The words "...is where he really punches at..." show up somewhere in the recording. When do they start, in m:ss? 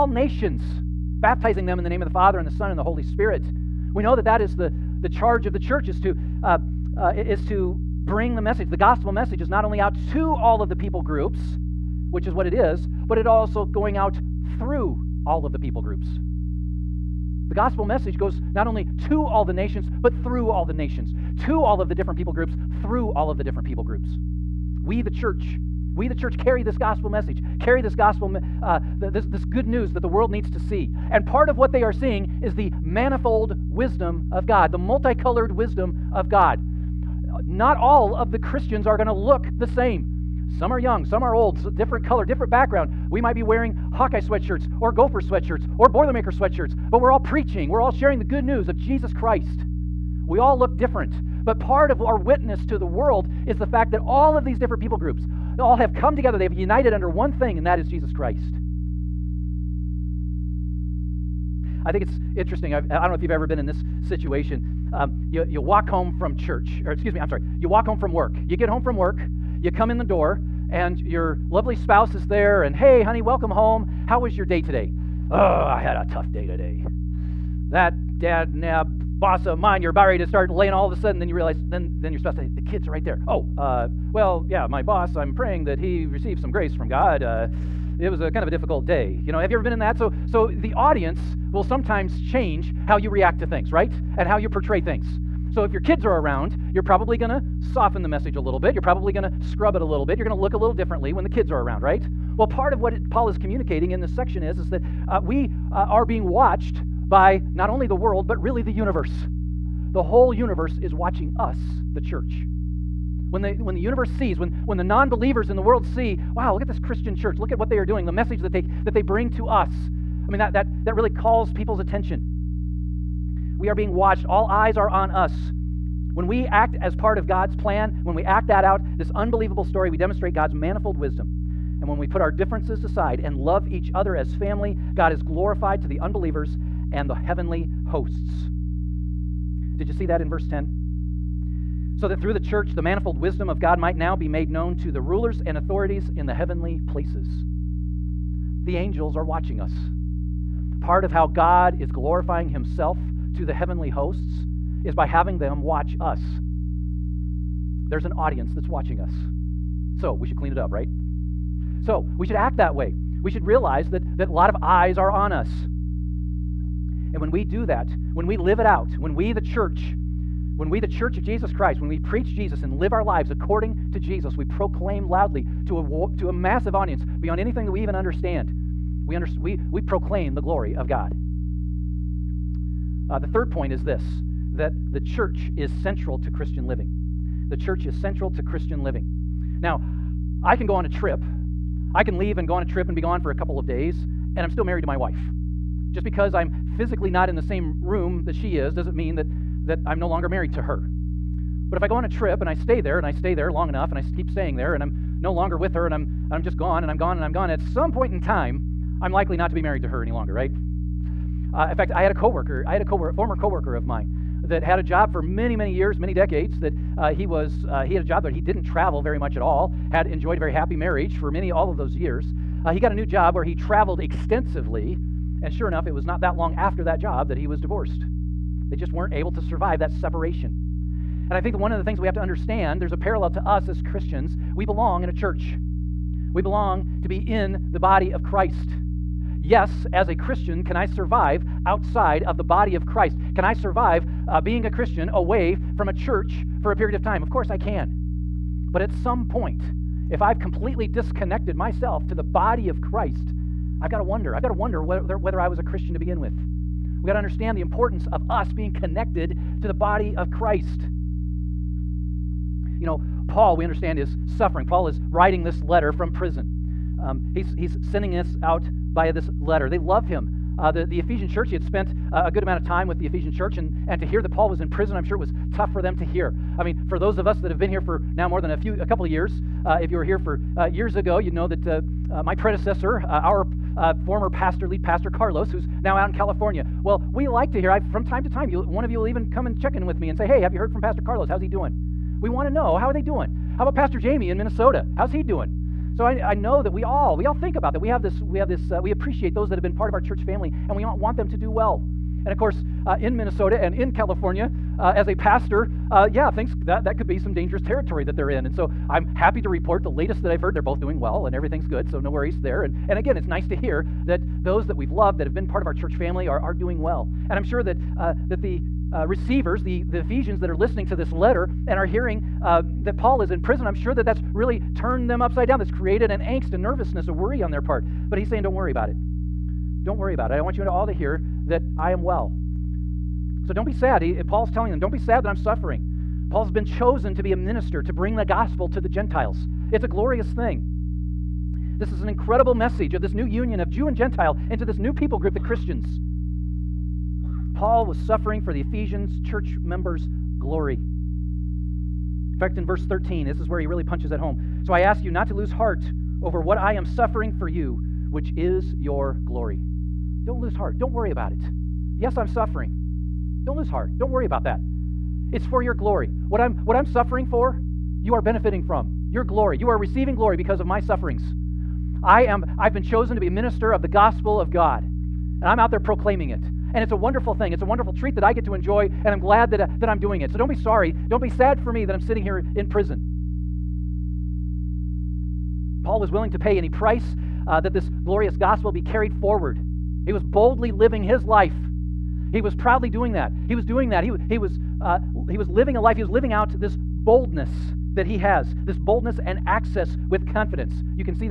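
5:53.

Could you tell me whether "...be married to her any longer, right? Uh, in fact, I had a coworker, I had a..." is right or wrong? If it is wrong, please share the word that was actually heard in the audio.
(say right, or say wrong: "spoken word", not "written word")
right.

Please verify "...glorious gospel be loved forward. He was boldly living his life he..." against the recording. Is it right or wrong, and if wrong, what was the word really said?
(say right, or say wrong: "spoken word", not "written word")
wrong: "carried", not "loved".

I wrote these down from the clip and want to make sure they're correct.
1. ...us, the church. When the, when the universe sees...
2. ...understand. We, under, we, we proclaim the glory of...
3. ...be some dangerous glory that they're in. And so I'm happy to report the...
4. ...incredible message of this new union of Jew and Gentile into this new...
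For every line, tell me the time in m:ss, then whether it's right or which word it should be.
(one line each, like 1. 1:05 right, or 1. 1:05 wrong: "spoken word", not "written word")
1. 1:51 right
2. 2:57 right
3. 5:07 wrong: "territory", not "glory"
4. 5:42 right.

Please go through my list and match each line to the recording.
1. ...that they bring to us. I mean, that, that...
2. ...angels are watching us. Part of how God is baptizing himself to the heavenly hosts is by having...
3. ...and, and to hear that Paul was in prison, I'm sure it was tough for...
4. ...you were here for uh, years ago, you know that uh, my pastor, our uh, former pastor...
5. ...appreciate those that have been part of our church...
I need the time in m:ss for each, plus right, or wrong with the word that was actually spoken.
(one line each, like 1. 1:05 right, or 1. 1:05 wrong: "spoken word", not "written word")
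1. 1:58 right
2. 2:28 wrong: "glorifying", not "baptizing"
3. 4:33 right
4. 4:39 wrong: "predecessor", not "pastor"
5. 4:58 right.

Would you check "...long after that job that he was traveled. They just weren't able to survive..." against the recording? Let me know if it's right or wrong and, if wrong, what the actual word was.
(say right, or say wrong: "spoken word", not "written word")
wrong: "divorced", not "traveled".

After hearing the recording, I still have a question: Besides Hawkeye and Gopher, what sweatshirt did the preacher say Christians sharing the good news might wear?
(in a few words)
Boilermaker.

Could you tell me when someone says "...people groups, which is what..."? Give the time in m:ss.
0:10.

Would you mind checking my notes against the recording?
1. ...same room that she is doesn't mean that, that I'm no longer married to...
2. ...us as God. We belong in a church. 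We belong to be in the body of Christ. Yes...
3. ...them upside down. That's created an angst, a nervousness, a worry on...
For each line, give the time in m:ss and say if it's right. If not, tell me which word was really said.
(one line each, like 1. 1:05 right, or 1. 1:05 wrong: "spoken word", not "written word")
1. 3:17 right
2. 3:53 wrong: "Christians", not "God"
3. 5:25 right.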